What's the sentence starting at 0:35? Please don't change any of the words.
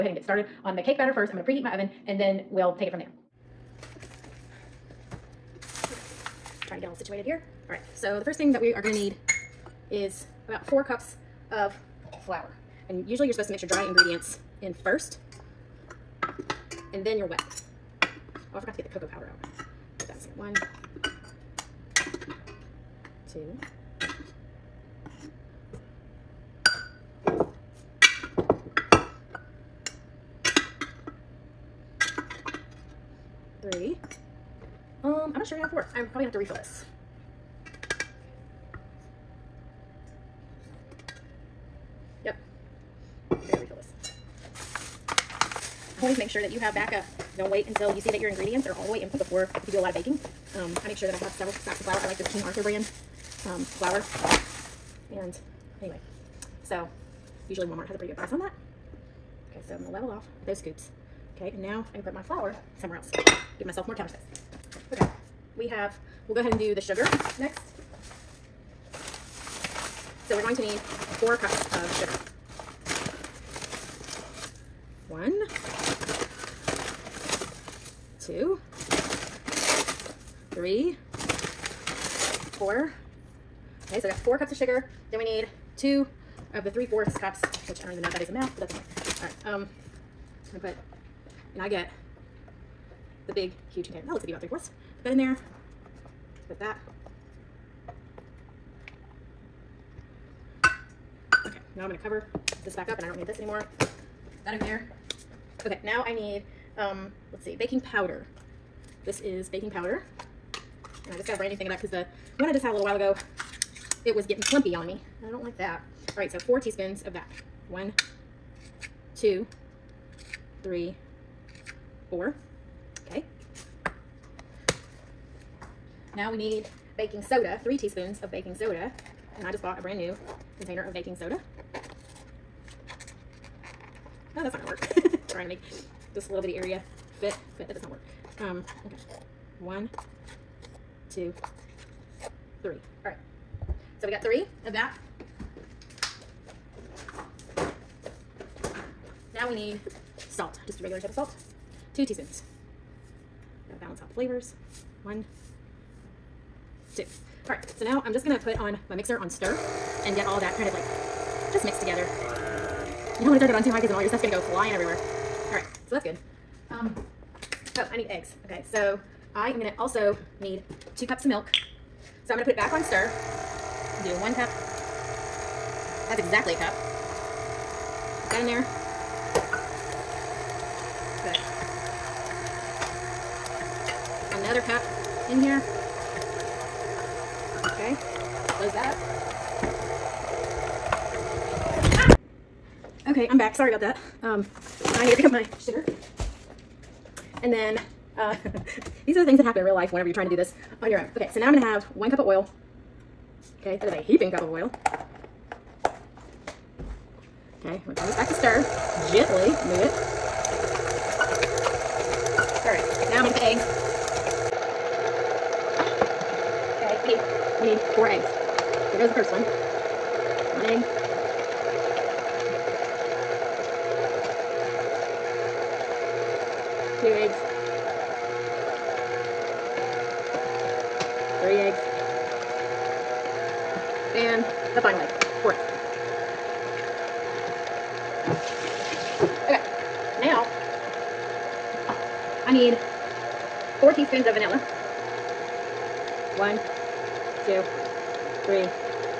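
I'm probably gonna have to refill this.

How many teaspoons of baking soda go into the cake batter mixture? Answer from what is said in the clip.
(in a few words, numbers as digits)
3.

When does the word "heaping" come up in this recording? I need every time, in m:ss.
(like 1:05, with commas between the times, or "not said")
3:24.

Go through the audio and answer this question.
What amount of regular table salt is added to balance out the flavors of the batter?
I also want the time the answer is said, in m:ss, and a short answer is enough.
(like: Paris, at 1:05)
2 teaspoons, at 2:31.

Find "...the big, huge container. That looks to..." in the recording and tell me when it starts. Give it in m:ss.
1:33.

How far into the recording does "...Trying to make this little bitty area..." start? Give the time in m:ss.
2:15.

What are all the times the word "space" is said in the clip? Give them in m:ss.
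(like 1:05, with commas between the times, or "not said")
1:04.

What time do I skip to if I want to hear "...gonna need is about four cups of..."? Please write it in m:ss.
0:08.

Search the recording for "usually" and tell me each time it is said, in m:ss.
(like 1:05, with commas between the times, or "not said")
0:13, 0:57.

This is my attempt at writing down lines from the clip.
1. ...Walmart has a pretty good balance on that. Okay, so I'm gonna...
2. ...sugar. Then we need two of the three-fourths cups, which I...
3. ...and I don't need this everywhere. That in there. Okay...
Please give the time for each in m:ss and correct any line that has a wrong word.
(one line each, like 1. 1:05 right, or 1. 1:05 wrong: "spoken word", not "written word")
1. 0:57 wrong: "price", not "balance"
2. 1:24 right
3. 1:42 wrong: "anymore", not "everywhere".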